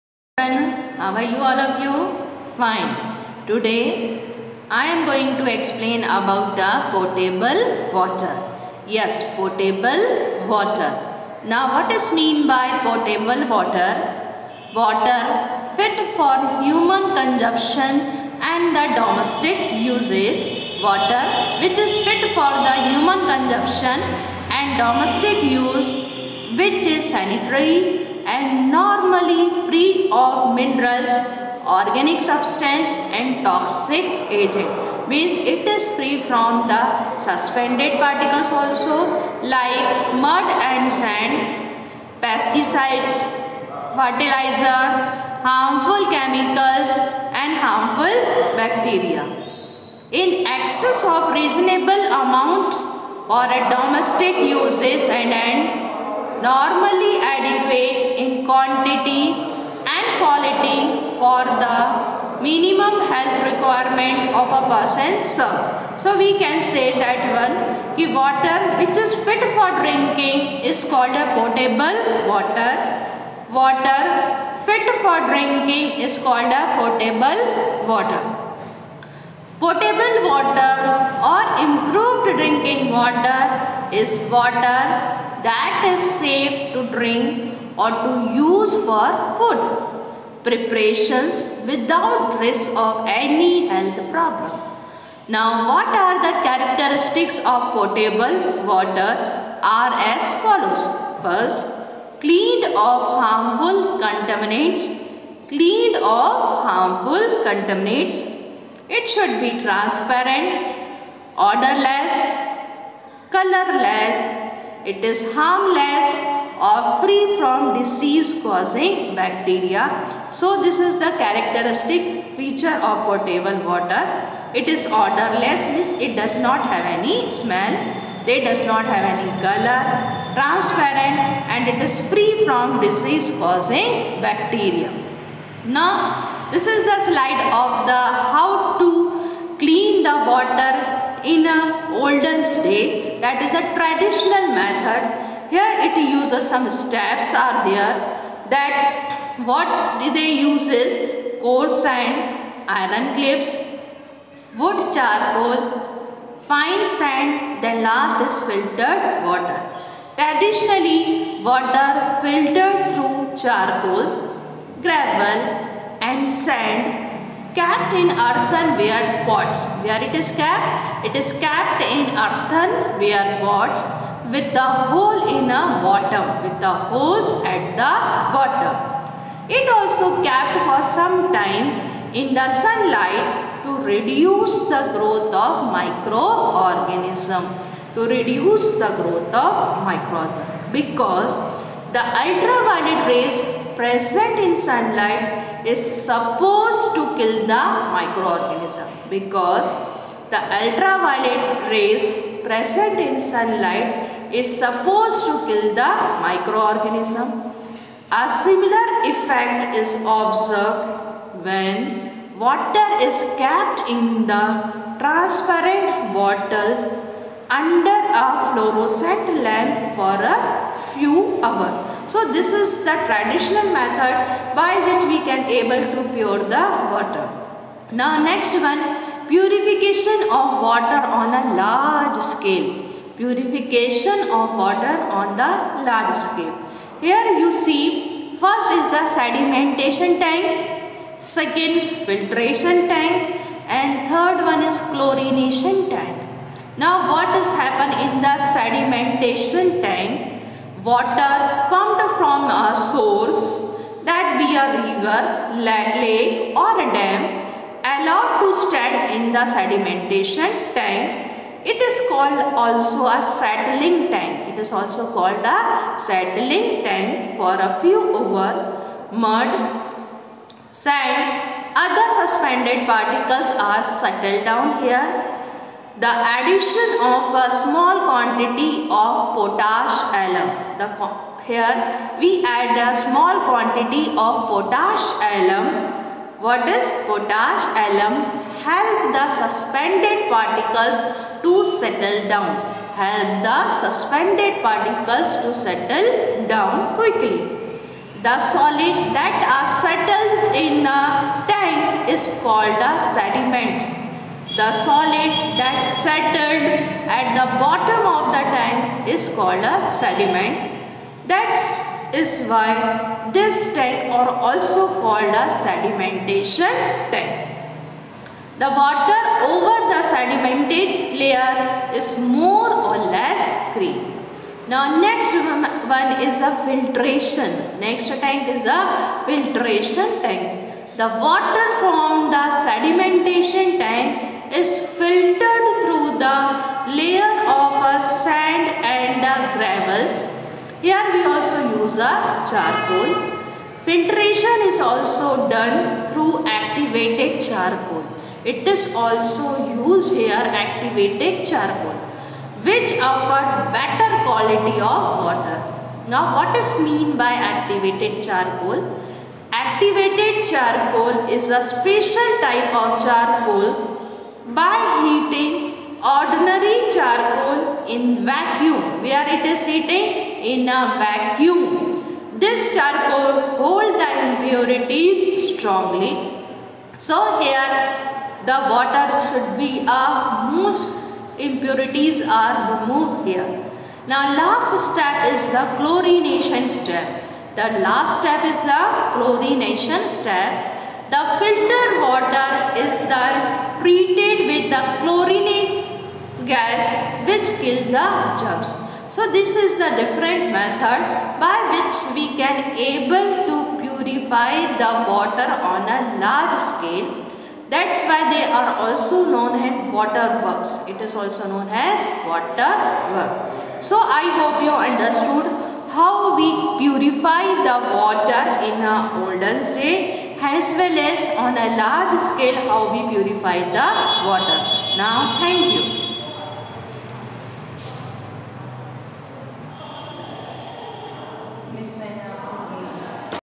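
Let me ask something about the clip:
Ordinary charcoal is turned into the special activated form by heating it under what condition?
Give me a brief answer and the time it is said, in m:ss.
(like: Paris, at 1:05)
In vacuum, at 6:07.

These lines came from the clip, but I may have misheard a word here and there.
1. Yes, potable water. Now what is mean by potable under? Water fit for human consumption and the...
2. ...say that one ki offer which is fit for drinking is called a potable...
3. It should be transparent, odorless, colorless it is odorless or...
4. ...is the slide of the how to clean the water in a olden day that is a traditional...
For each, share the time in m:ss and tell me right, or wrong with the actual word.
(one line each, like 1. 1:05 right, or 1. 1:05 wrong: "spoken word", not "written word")
1. 0:08 wrong: "water", not "under"
2. 1:06 wrong: "water", not "offer"
3. 1:48 wrong: "harmless", not "odorless"
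4. 2:16 right.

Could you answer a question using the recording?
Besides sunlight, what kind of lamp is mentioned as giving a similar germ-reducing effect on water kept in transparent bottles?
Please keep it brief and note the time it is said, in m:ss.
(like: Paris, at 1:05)
Fluorescent lamp, at 3:38.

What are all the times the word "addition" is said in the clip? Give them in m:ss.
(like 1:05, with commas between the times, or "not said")
4:36.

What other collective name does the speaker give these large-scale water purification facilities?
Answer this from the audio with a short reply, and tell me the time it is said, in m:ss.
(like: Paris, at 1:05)
Water works, at 6:49.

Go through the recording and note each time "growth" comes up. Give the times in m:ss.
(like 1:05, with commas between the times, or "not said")
3:04, 3:08.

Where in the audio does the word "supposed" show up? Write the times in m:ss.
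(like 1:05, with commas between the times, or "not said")
3:16, 3:24.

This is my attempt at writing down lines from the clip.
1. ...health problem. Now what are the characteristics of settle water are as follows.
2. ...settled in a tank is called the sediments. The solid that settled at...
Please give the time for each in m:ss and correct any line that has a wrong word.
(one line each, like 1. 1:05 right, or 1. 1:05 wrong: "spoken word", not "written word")
1. 1:33 wrong: "potable", not "settle"
2. 4:59 right.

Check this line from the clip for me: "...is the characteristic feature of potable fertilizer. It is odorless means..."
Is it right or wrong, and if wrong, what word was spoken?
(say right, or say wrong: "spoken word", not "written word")
wrong: "water", not "fertilizer".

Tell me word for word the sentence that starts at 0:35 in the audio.
Means it is free from the suspended particles also like mud and sand, pesticides, fertilizer, harmful chemicals and harmful bacteria.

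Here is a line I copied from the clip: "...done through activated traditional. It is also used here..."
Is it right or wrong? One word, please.
wrong.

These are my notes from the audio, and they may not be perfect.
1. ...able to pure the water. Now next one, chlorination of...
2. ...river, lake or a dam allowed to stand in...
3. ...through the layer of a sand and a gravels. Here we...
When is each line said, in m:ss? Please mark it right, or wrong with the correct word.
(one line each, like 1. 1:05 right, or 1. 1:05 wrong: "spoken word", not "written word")
1. 3:45 wrong: "purification", not "chlorination"
2. 4:14 right
3. 5:35 right.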